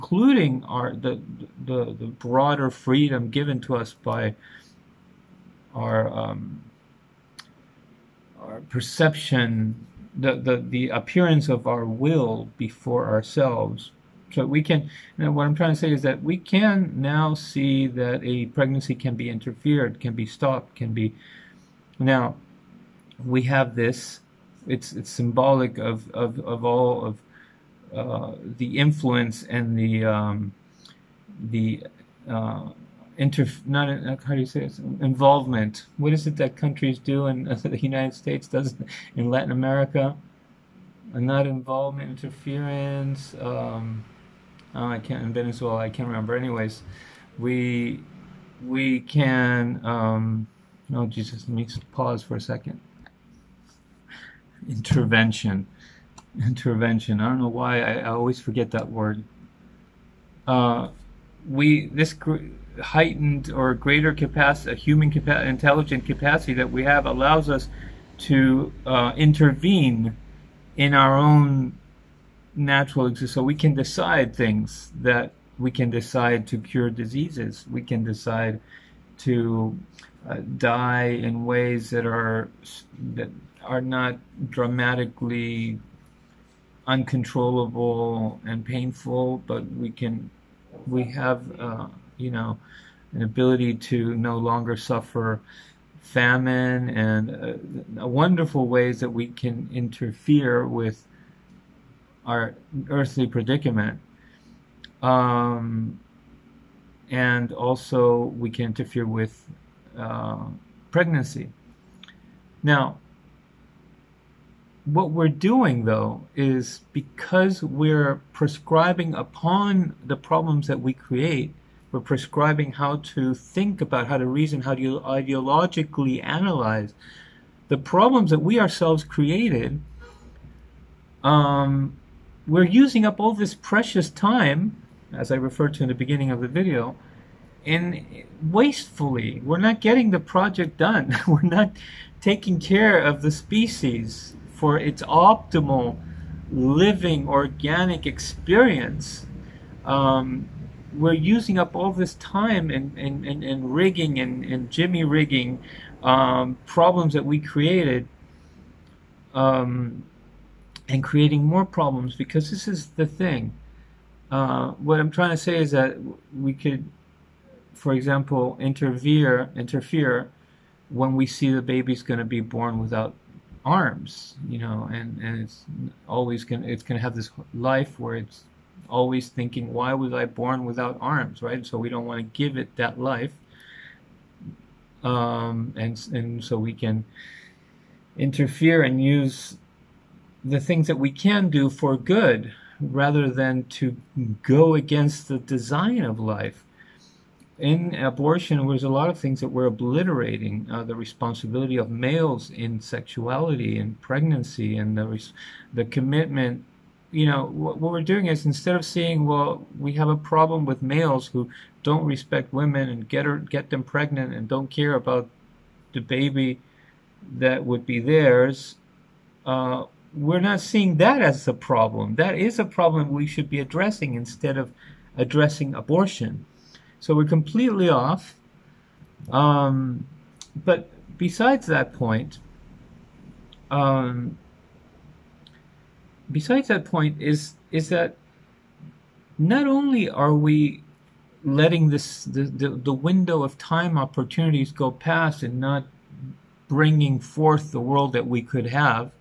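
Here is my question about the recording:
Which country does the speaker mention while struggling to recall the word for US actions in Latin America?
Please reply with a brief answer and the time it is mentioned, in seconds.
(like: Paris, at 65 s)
Venezuela, at 45 s.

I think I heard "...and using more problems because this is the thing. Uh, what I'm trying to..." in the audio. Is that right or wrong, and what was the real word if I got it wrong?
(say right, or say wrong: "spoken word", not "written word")
wrong: "creating", not "using".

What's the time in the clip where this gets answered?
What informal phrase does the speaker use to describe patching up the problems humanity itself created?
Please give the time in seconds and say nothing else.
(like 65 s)
154 s.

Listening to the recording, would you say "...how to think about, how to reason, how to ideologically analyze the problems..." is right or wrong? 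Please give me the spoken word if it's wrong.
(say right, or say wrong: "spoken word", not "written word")
right.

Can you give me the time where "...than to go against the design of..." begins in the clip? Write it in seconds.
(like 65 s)
193 s.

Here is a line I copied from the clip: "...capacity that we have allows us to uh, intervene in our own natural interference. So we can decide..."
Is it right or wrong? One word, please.
wrong.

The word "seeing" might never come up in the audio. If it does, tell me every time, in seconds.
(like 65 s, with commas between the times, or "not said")
208 s, 220 s.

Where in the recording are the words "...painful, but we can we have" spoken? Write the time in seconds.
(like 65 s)
88 s.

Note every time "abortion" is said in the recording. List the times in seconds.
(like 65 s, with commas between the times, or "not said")
197 s, 225 s.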